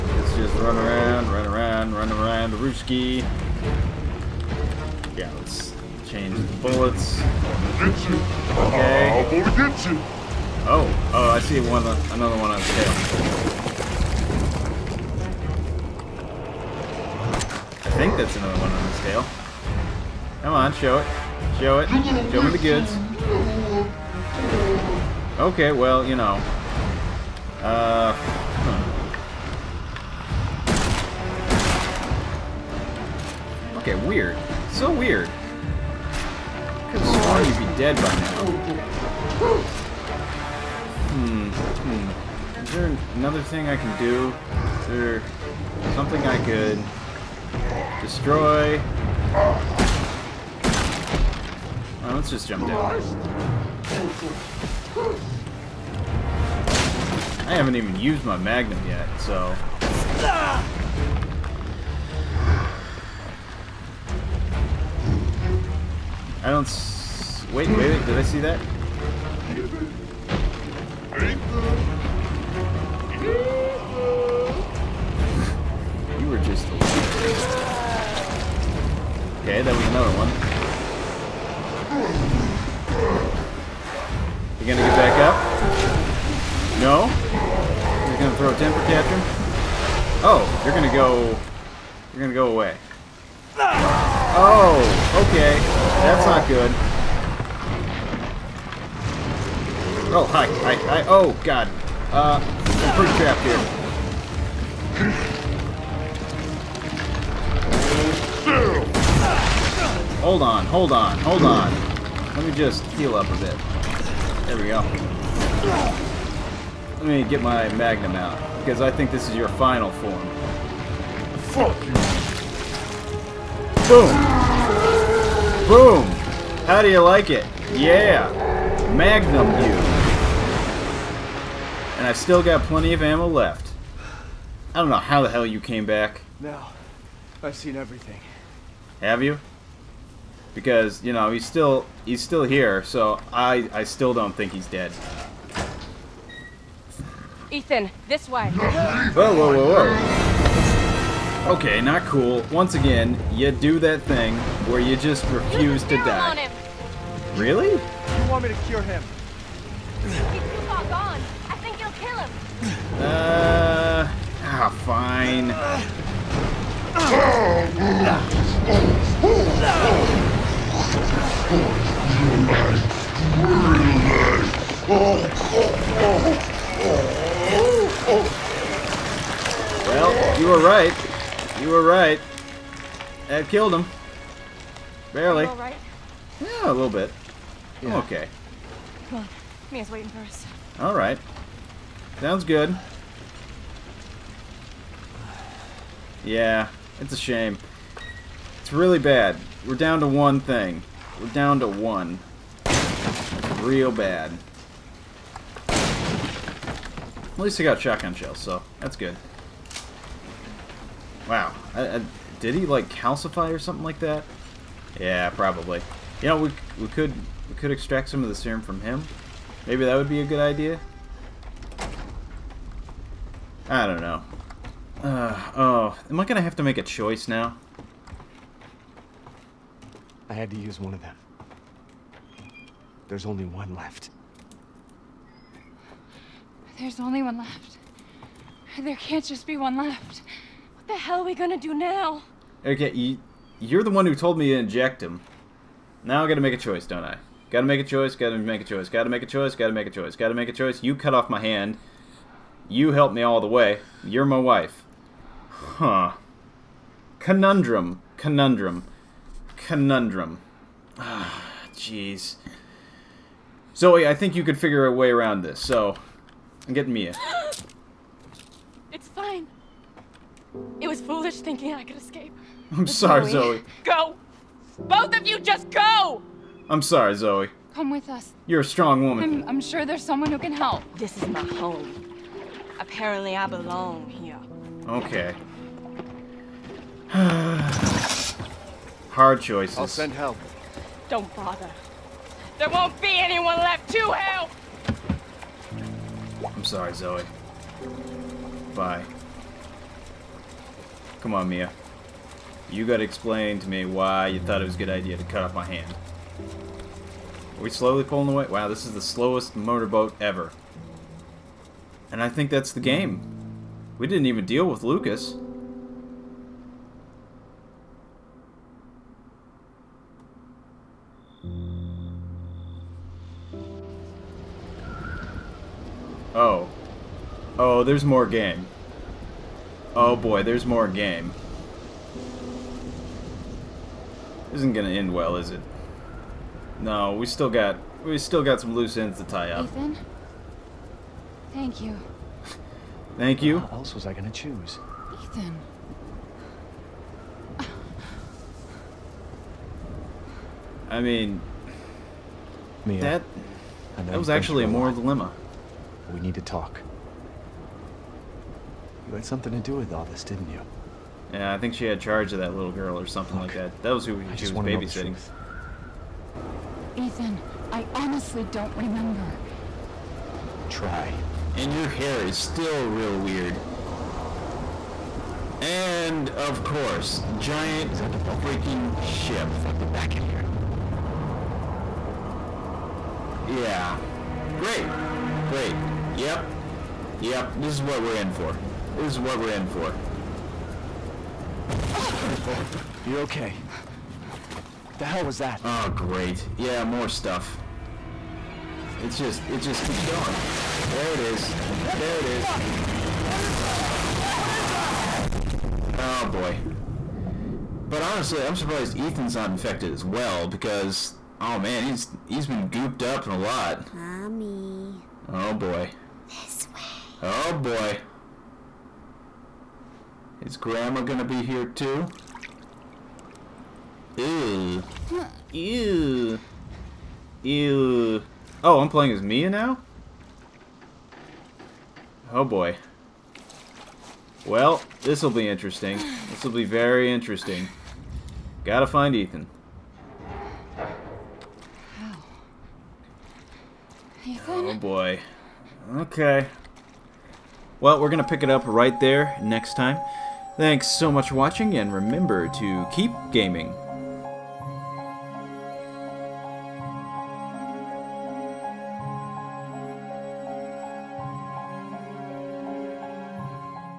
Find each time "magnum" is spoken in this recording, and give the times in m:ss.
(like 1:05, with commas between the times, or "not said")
0:58, 1:57, 2:08.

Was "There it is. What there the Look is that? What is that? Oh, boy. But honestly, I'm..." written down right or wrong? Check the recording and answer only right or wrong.
wrong.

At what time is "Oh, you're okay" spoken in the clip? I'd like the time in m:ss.
6:32.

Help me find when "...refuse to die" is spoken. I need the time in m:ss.
2:35.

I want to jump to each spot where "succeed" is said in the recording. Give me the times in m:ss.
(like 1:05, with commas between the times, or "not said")
not said.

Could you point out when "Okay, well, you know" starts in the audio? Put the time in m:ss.
0:25.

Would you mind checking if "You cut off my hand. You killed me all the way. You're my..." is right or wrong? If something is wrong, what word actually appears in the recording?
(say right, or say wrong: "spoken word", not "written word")
wrong: "helped", not "killed".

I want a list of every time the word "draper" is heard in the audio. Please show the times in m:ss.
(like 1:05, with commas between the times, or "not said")
not said.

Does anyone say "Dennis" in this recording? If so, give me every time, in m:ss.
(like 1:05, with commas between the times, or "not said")
not said.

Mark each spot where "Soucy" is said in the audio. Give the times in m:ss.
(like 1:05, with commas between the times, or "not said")
not said.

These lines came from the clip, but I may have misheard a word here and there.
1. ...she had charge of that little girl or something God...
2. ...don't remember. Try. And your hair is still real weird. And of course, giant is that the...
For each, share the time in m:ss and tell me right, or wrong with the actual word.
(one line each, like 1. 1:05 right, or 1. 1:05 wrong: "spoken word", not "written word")
1. 6:01 wrong: "Look", not "God"
2. 6:08 right.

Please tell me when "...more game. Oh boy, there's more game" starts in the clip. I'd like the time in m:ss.
5:28.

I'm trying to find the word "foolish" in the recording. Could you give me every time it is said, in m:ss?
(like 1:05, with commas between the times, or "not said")
4:31.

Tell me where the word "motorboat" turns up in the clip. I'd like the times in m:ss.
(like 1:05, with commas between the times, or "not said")
5:09.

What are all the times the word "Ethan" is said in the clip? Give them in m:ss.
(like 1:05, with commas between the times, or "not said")
2:27, 5:39, 5:45, 6:06, 6:48, 7:19, 7:24.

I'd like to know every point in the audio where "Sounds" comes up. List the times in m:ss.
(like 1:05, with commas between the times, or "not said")
3:12.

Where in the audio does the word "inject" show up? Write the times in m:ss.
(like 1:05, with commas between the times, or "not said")
4:04.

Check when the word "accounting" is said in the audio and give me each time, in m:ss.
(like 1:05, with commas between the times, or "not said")
not said.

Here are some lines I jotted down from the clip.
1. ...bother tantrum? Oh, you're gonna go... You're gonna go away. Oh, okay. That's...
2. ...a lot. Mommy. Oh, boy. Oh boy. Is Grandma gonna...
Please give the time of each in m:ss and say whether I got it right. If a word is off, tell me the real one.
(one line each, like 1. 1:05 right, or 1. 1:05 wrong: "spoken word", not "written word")
1. 1:28 wrong: "temper", not "bother"
2. 6:53 right.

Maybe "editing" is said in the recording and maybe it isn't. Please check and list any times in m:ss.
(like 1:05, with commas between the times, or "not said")
not said.